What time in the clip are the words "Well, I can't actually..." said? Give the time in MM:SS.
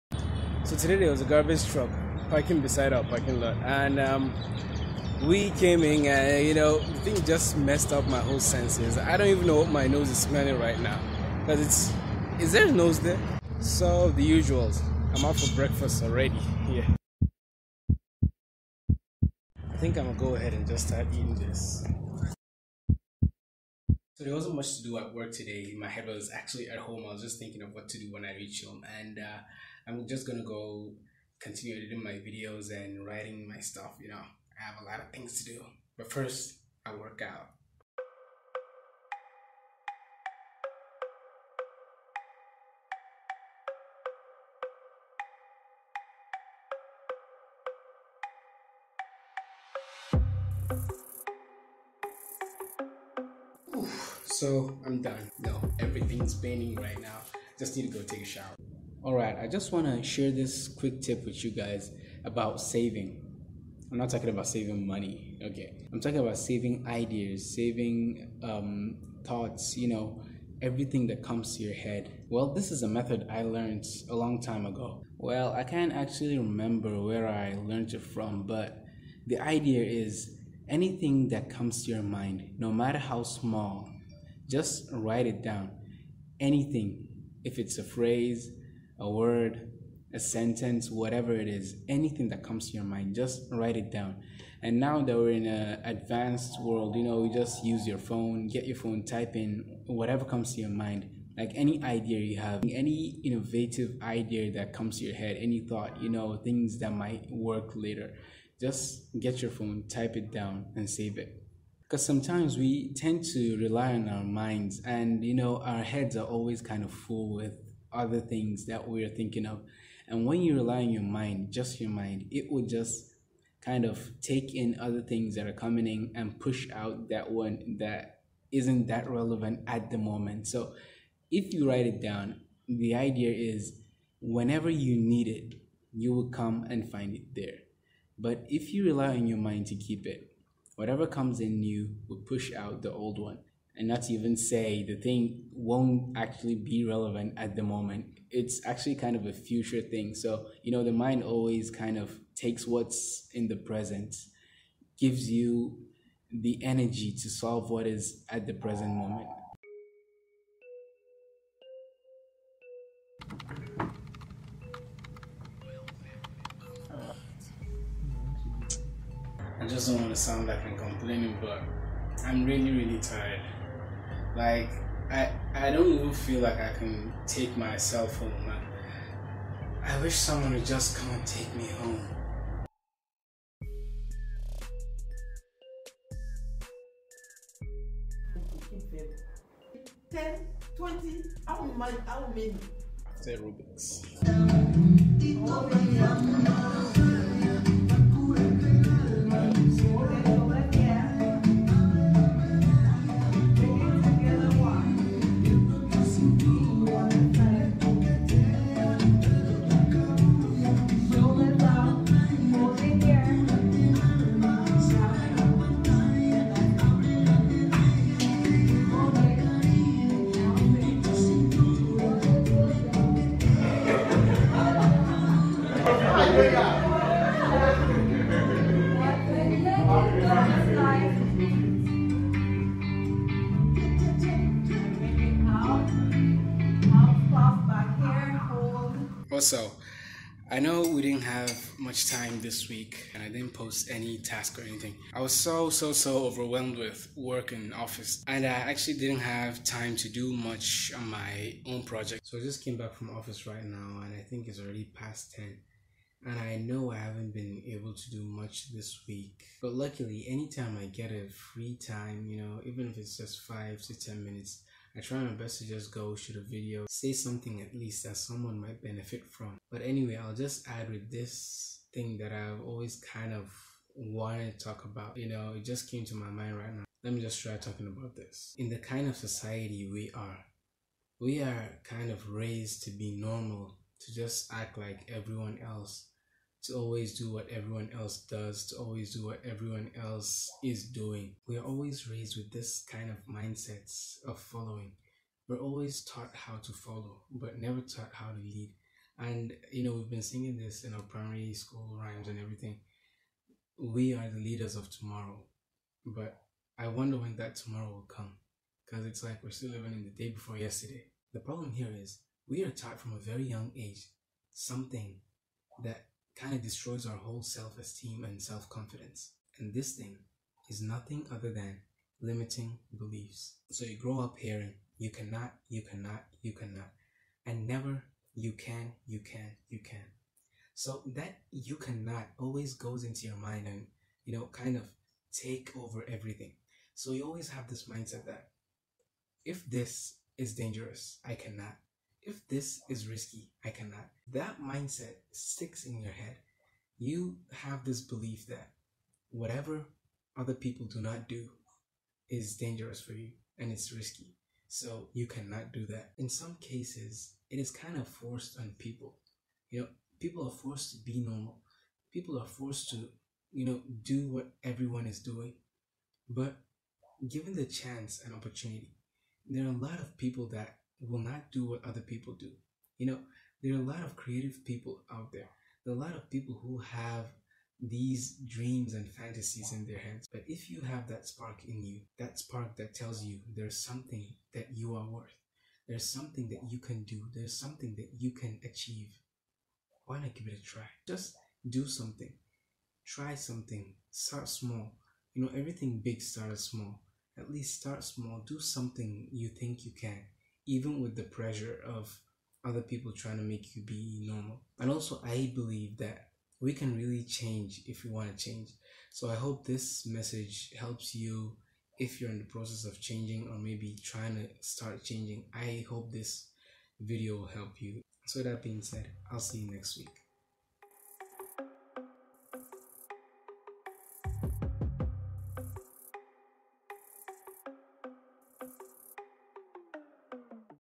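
01:15.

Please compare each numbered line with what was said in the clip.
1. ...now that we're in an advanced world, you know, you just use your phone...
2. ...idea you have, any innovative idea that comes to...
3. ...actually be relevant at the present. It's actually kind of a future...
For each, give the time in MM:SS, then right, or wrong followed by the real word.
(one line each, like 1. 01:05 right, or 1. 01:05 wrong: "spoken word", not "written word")
1. 01:34 right
2. 01:41 right
3. 02:26 wrong: "moment", not "present".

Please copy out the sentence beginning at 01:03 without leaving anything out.
I'm not talking about saving money, okay?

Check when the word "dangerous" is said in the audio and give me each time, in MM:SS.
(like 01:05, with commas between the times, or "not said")
05:40, 05:52.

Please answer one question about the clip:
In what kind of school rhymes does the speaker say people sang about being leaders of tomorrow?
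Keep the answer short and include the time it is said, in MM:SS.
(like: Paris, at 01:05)
Primary school, at 05:01.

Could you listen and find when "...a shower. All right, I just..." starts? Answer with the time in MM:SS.
00:58.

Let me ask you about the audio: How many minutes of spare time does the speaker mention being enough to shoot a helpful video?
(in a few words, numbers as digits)
5 to 10 minutes.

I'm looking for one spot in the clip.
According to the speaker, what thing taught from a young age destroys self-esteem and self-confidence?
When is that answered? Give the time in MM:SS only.
05:22.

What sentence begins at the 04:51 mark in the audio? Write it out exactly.
We are always raised with this kind of mindsets of following.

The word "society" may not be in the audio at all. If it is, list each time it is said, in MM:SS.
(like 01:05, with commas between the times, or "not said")
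04:39.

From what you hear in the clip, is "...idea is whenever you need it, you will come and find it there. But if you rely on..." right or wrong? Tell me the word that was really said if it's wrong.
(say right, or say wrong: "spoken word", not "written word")
right.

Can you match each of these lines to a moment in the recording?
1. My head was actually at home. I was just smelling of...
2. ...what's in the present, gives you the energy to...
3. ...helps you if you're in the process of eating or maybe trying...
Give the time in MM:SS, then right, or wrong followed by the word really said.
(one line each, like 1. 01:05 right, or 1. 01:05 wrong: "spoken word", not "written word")
1. 00:25 wrong: "thinking", not "smelling"
2. 02:32 right
3. 06:50 wrong: "changing", not "eating".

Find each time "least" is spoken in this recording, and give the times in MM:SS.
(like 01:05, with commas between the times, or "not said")
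04:27, 06:37.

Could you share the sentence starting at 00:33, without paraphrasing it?
You know, I have a lot of things to do.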